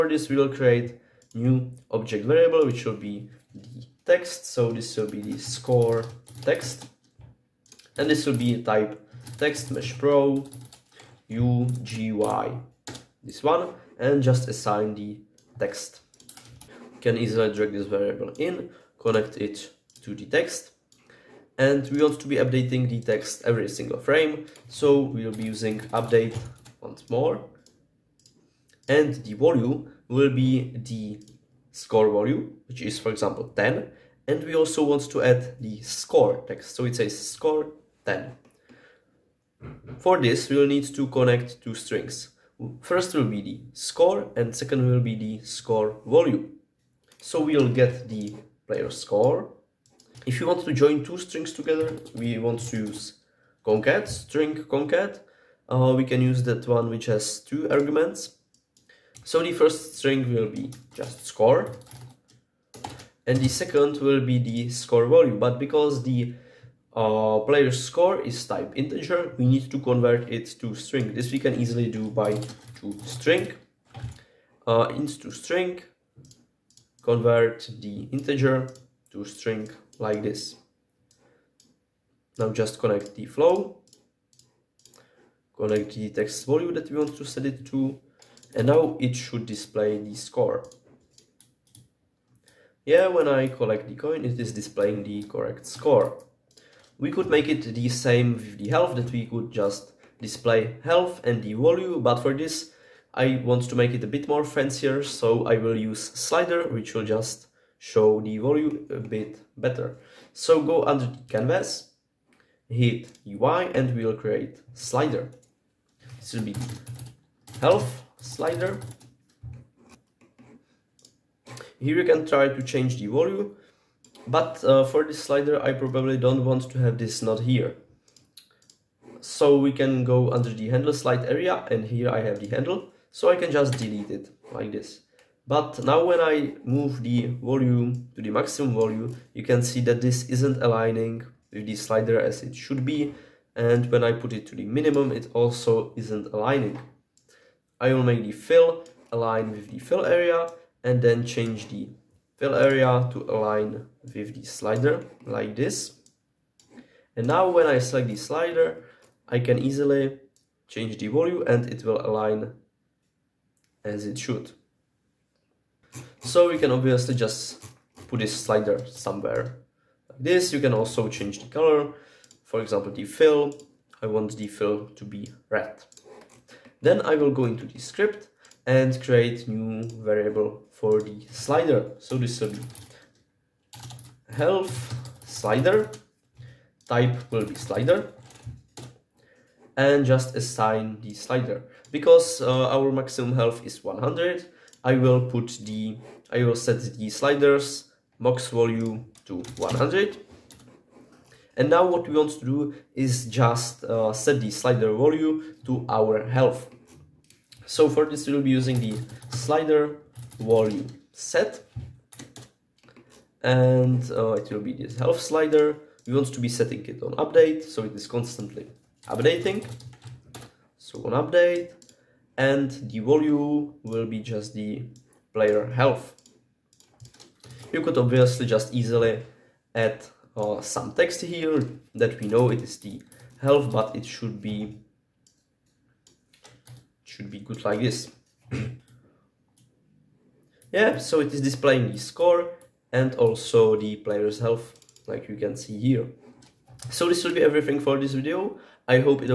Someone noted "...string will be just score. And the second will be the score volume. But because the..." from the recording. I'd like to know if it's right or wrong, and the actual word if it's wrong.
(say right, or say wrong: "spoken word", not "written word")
right.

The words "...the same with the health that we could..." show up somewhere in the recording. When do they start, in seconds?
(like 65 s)
97 s.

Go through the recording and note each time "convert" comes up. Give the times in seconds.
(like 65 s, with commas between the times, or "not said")
69 s, 77 s.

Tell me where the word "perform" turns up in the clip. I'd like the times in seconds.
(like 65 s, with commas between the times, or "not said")
not said.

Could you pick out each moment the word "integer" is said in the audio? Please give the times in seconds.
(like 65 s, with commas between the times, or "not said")
68 s, 78 s.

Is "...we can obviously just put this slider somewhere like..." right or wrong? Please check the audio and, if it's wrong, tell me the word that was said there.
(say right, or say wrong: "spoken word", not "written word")
right.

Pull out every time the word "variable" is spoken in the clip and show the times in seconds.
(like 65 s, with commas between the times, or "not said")
2 s, 17 s, 180 s.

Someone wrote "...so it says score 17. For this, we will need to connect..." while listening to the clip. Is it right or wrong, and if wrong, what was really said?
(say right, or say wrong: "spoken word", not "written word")
wrong: "10", not "17".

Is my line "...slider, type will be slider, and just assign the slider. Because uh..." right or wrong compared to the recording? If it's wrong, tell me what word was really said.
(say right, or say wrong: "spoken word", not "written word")
right.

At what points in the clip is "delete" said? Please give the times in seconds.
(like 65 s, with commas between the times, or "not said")
133 s.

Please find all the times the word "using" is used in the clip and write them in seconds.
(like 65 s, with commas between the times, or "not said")
25 s, 208 s.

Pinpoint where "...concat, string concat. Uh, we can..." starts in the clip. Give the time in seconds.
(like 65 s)
53 s.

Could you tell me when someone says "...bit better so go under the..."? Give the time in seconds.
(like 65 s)
108 s.